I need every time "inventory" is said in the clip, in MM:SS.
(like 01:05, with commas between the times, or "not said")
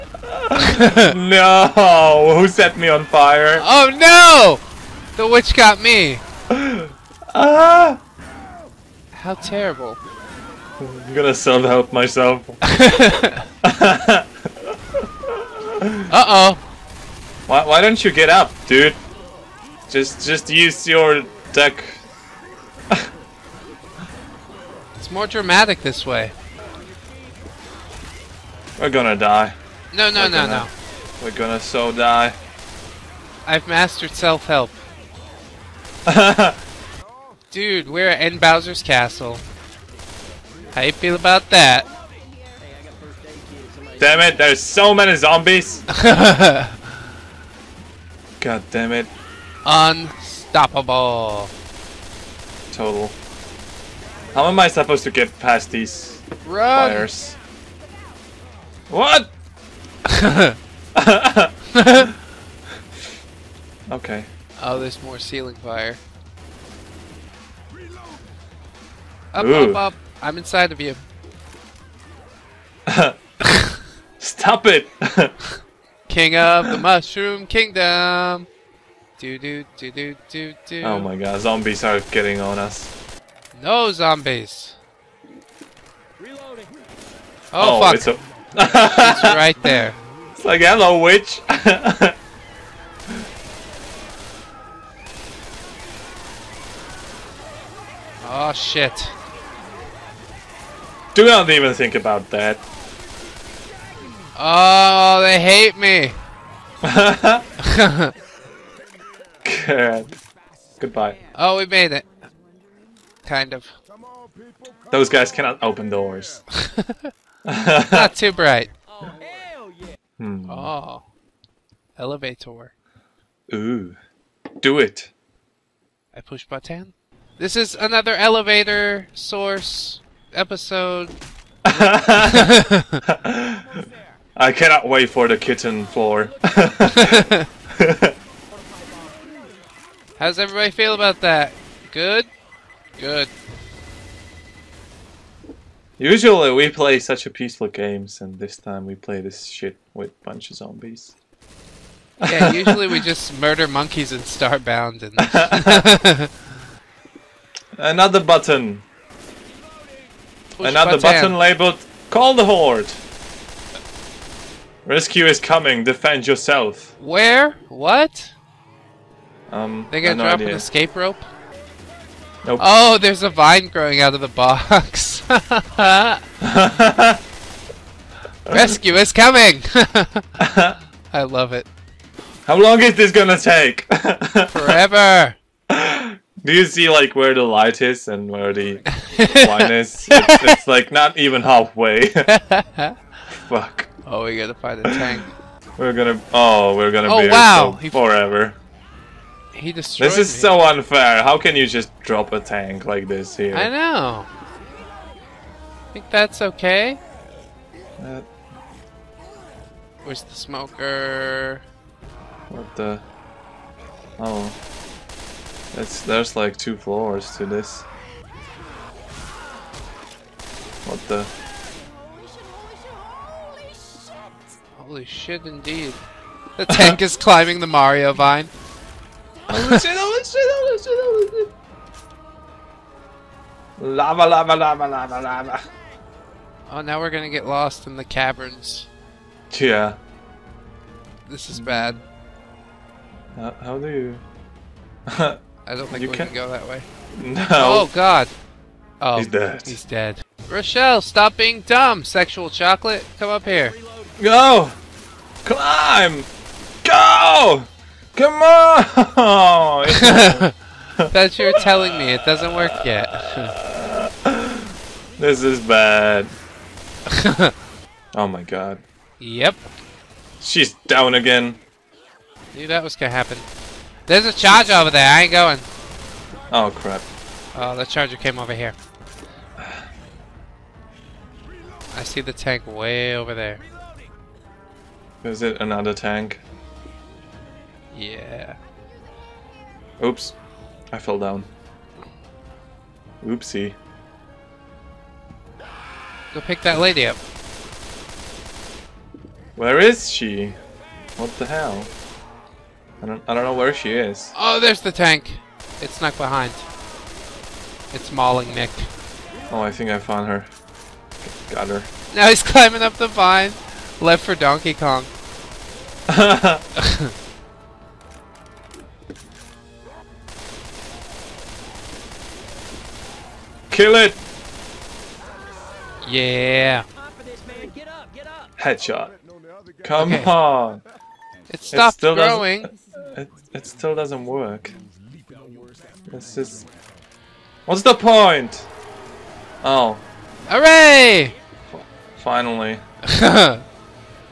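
not said.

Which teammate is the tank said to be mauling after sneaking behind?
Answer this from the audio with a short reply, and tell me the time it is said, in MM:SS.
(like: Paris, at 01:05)
Nick, at 05:08.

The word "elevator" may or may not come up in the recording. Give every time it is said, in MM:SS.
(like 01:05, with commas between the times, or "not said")
02:01, 02:08.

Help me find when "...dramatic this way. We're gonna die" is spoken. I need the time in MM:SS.
00:25.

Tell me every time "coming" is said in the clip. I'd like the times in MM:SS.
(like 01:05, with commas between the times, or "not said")
02:45, 02:59.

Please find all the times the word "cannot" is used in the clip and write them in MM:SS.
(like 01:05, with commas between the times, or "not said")
01:55, 02:14.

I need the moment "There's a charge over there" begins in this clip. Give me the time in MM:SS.
04:34.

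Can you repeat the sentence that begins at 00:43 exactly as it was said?
Damn it, there's so many zombies!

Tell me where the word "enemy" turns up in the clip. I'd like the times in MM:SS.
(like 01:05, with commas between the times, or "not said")
not said.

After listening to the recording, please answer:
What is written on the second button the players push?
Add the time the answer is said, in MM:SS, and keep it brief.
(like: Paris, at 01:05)
Call the Horde, at 02:42.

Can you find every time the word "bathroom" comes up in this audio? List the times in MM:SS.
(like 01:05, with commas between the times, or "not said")
not said.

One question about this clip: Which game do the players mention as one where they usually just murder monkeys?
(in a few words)
Starbound.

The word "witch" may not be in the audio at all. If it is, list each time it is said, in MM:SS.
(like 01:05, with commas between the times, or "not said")
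00:05, 01:30.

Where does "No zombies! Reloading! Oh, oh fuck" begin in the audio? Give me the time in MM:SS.
01:23.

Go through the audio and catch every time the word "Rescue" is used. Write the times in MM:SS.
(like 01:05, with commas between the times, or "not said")
02:44, 02:58.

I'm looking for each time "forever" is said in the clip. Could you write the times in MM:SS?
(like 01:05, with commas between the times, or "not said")
03:04, 03:17.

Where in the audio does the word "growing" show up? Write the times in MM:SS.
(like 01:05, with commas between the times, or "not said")
02:53, 05:32.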